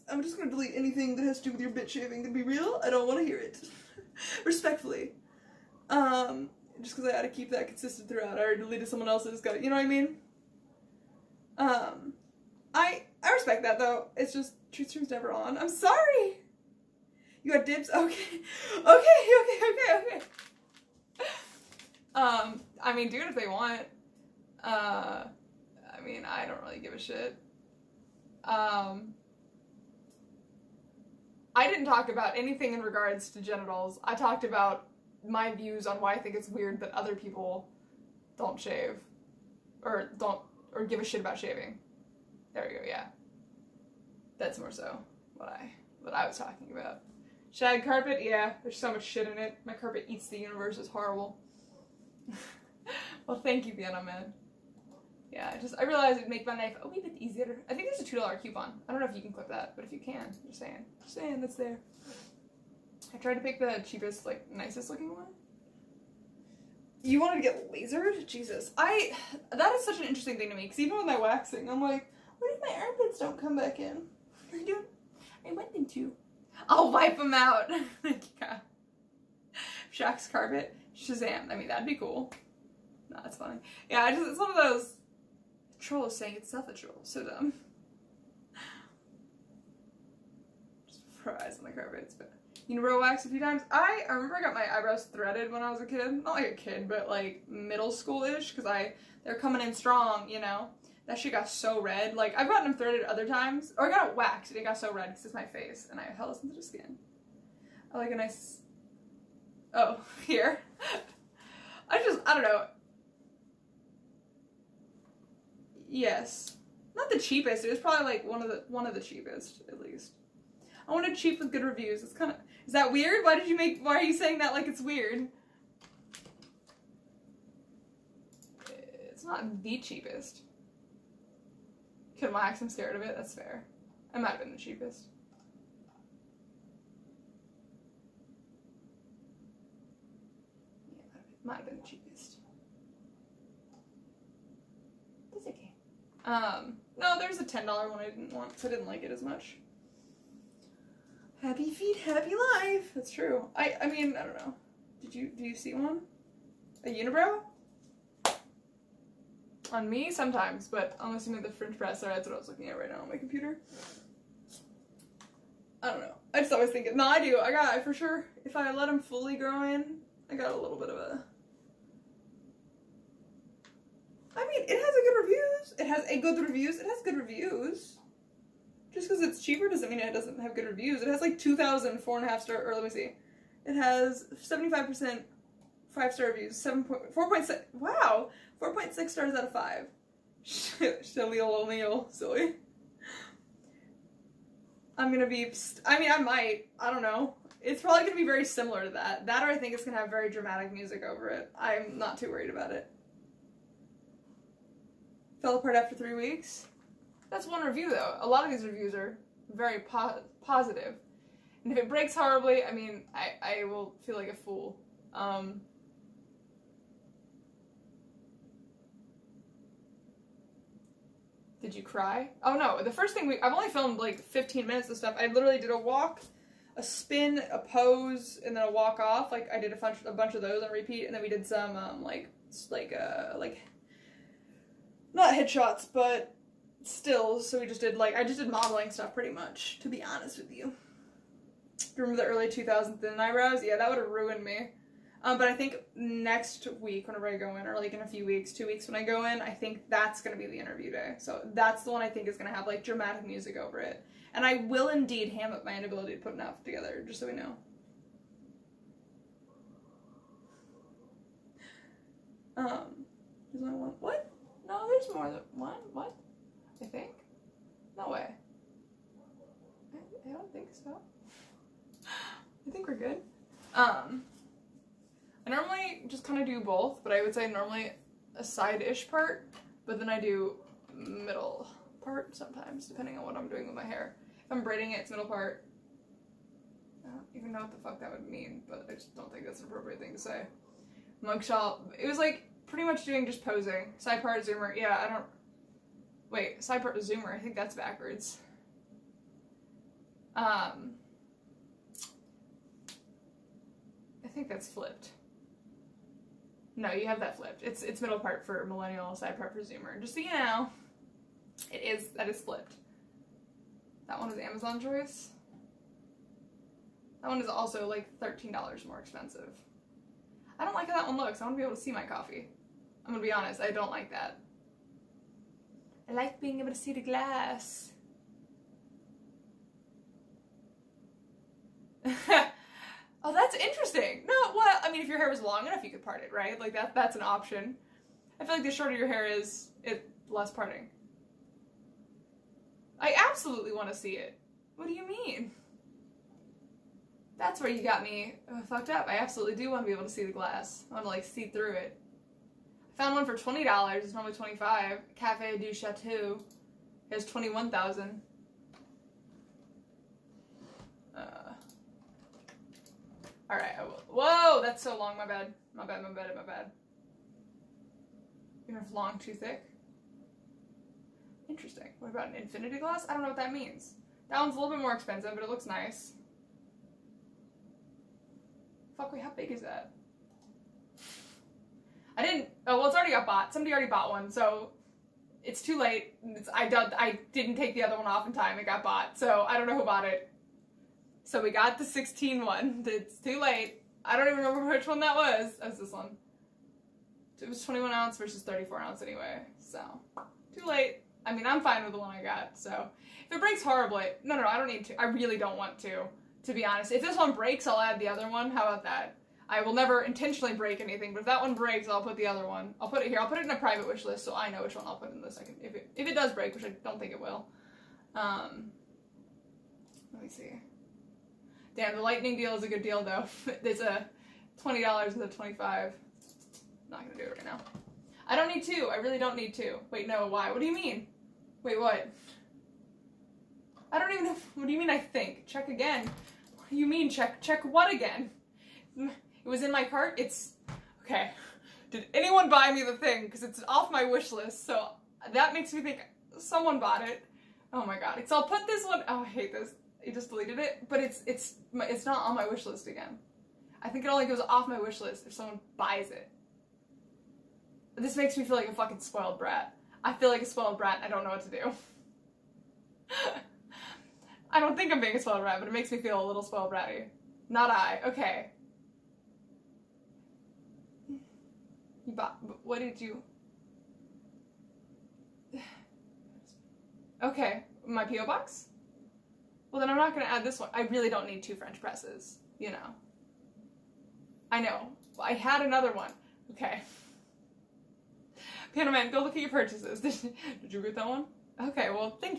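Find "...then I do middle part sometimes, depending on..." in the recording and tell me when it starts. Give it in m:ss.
4:39.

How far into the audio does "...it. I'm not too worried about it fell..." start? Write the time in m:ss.
3:21.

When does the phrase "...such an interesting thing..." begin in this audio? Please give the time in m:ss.
1:09.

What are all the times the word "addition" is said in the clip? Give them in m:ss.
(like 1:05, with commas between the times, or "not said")
not said.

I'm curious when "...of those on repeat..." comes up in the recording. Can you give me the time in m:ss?
3:50.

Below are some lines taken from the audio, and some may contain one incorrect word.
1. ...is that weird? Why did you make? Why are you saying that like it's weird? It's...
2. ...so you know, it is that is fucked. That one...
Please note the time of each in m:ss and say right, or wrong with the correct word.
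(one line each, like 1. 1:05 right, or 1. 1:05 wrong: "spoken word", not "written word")
1. 2:02 right
2. 5:10 wrong: "flipped", not "fucked".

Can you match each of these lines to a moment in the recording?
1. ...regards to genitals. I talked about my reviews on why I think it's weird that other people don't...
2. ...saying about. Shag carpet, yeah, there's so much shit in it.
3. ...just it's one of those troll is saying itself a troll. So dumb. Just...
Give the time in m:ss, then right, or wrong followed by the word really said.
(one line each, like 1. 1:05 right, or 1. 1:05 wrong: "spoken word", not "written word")
1. 0:32 wrong: "views", not "reviews"
2. 0:46 wrong: "talking", not "saying"
3. 1:24 right.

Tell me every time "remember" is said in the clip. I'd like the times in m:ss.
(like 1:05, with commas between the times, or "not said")
1:34, 4:01, 6:34.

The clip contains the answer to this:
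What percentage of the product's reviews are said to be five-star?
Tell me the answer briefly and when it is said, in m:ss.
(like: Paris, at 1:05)
75%, at 3:04.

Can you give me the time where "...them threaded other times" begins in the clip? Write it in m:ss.
1:42.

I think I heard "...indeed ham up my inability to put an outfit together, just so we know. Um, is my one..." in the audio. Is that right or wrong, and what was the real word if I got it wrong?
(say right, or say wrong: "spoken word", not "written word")
right.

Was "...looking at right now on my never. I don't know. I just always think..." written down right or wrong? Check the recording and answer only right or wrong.
wrong.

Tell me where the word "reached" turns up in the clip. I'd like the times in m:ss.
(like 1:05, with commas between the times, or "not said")
not said.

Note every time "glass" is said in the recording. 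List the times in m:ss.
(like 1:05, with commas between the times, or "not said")
5:27, 5:50, 6:12.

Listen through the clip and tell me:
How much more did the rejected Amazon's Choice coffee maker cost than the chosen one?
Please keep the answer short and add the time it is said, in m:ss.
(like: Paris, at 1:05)
$13, at 5:18.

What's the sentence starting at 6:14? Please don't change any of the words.
That one's a little bit more expensive, but it looks nice.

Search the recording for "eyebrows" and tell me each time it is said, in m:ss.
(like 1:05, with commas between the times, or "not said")
1:34, 4:03.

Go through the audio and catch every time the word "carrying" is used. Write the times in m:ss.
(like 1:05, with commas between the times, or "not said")
not said.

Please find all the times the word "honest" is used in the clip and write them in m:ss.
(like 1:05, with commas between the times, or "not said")
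4:00, 5:23, 6:46.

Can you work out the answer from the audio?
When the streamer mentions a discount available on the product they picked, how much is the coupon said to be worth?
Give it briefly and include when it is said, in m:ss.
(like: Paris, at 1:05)
$2, at 0:58.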